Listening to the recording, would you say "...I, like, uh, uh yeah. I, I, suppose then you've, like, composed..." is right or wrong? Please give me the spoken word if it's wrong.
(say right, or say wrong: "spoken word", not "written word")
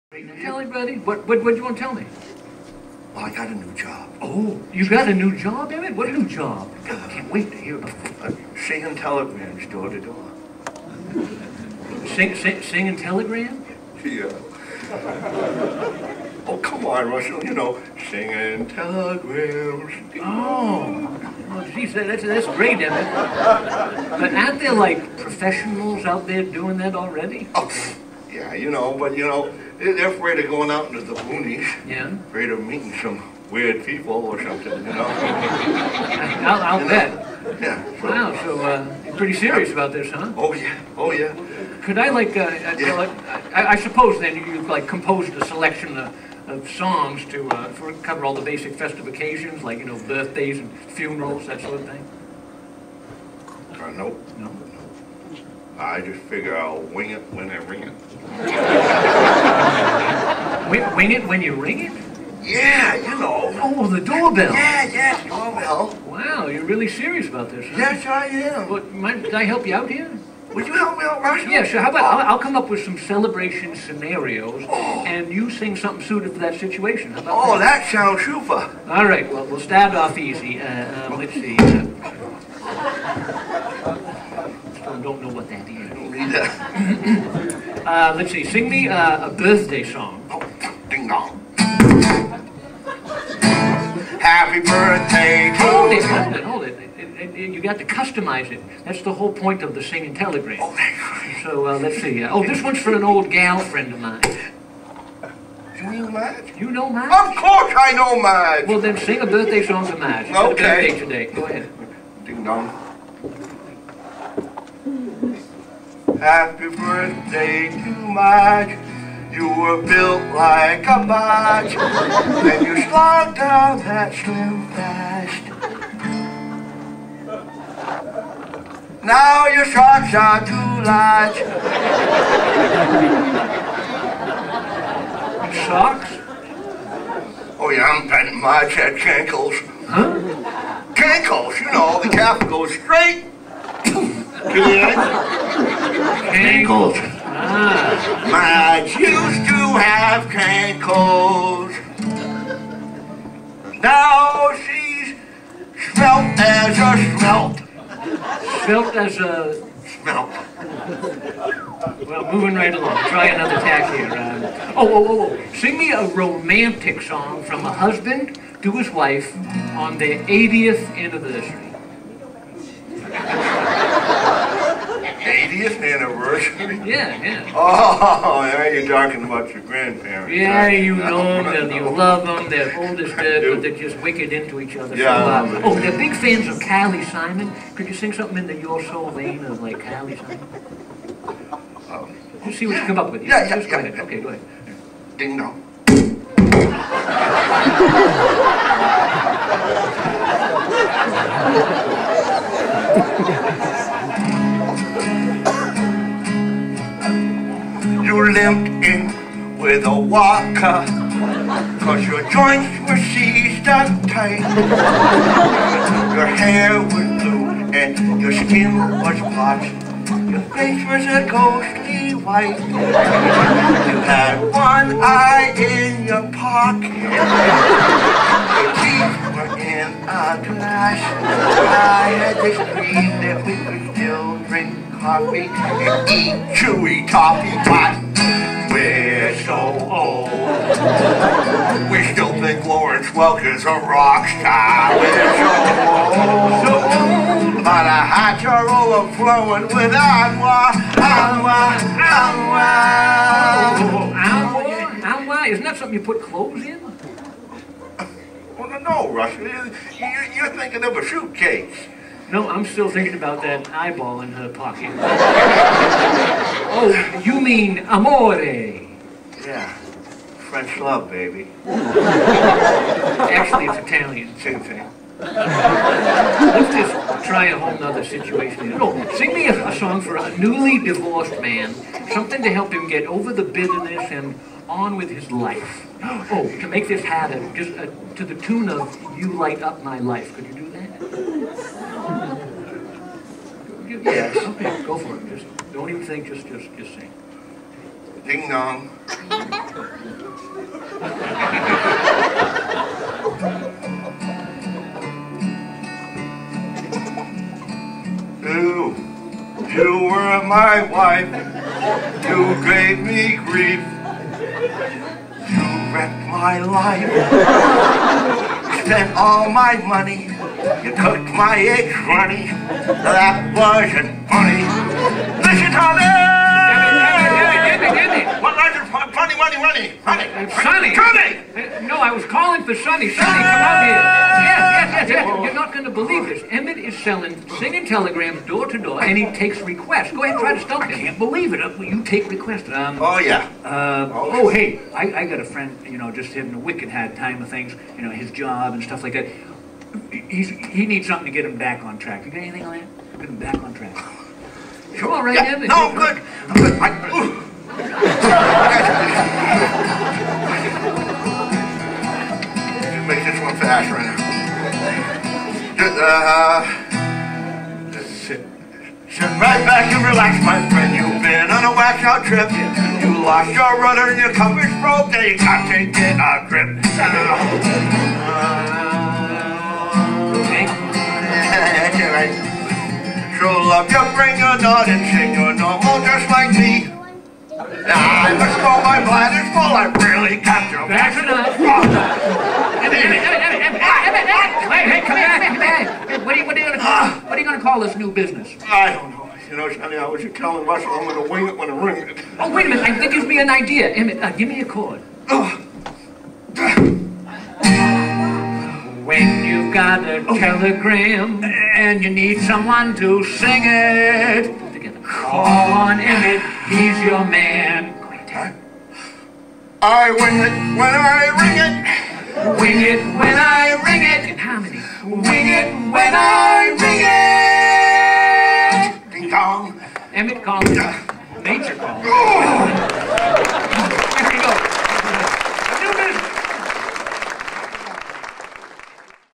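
right.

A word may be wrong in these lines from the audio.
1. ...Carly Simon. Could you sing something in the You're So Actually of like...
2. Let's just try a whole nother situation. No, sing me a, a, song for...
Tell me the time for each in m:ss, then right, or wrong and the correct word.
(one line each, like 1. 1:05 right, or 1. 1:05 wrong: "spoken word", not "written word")
1. 3:06 wrong: "Vain", not "Actually"
2. 4:35 right.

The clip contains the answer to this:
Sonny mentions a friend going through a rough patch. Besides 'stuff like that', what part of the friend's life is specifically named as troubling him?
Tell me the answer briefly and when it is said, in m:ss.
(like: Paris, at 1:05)
His job, at 5:48.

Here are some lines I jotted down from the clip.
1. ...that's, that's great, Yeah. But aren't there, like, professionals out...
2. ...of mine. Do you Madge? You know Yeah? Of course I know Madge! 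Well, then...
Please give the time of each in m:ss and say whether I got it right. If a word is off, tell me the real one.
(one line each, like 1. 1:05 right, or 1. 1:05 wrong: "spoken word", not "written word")
1. 0:21 wrong: "Emmett", not "Yeah"
2. 1:43 wrong: "Madge", not "Yeah".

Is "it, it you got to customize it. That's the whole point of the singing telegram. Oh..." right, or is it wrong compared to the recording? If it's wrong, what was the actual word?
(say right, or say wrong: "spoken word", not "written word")
right.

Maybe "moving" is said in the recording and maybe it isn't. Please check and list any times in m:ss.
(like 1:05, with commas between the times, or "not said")
2:42.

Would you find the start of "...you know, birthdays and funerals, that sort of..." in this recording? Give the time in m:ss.
0:49.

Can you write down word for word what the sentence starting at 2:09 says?
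Now your socks are too large.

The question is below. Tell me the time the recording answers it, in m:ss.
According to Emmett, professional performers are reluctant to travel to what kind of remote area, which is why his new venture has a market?
0:31.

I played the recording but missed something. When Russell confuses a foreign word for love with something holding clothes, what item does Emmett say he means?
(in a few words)
A suitcase.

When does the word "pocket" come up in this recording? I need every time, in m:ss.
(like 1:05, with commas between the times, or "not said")
3:46, 4:24.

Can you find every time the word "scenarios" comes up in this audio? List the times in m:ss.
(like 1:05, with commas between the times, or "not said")
1:13.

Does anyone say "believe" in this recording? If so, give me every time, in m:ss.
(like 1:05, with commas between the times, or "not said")
5:35, 5:41.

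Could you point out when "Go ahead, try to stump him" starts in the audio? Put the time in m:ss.
5:40.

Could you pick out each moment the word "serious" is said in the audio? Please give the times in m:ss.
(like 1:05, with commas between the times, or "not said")
0:39, 1:06.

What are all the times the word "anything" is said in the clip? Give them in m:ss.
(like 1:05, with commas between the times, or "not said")
5:52.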